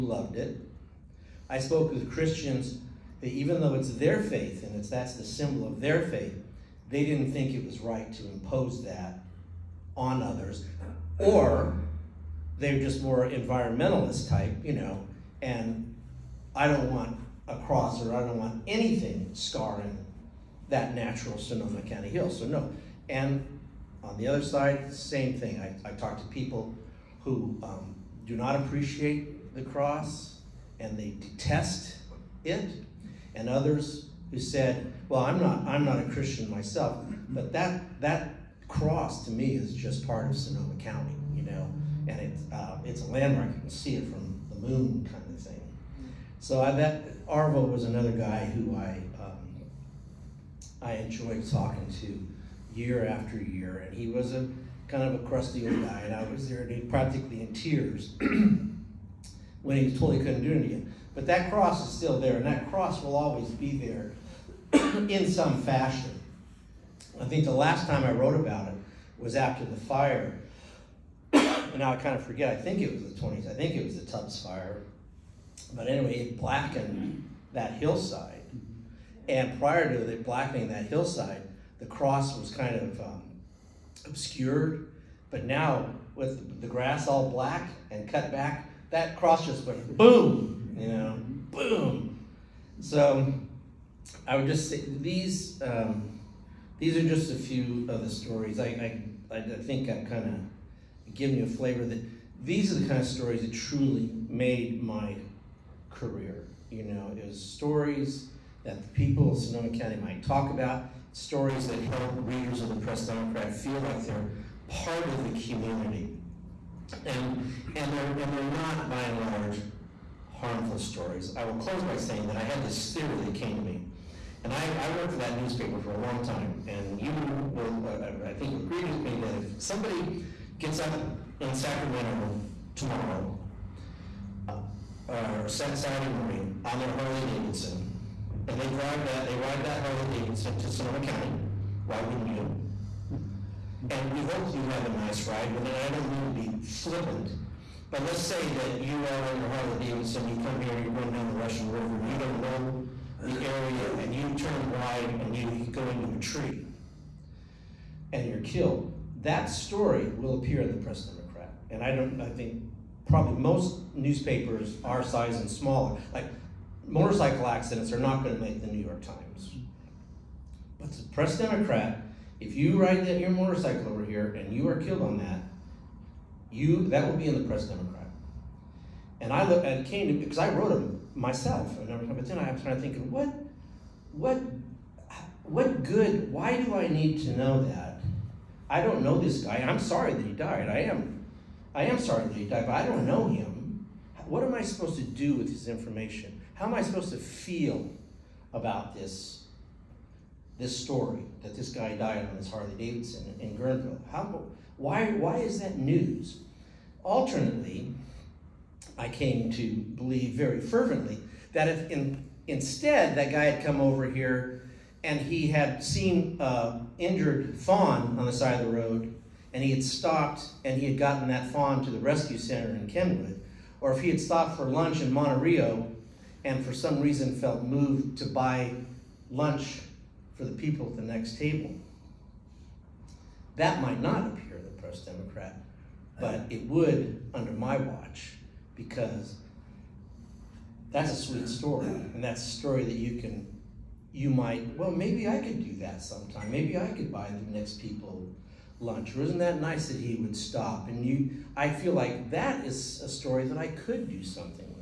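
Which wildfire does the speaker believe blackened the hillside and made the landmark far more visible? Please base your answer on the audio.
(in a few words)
Tubbs fire.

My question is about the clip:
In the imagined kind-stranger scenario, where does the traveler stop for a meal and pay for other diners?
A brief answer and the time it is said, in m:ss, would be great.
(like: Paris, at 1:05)
Monte Rio, at 3:45.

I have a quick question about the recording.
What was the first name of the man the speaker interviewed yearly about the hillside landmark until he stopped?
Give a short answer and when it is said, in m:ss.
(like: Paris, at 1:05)
Arvo, at 0:47.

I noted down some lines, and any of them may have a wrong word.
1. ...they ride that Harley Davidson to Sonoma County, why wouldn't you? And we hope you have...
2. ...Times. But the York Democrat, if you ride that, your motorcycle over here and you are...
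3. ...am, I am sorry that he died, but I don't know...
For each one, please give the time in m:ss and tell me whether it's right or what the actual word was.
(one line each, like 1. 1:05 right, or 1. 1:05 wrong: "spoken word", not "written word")
1. 2:19 right
2. 2:49 wrong: "Press", not "York"
3. 3:10 right.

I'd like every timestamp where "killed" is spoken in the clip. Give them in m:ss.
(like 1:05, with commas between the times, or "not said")
2:38, 2:54.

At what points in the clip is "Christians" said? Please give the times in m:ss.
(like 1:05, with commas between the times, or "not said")
0:02, 0:36.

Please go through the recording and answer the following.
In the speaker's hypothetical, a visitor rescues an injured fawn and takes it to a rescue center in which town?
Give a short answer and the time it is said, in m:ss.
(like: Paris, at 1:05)
Kenwood, at 3:42.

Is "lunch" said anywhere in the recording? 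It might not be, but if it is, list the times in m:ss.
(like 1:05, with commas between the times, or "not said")
3:44, 3:49, 4:08.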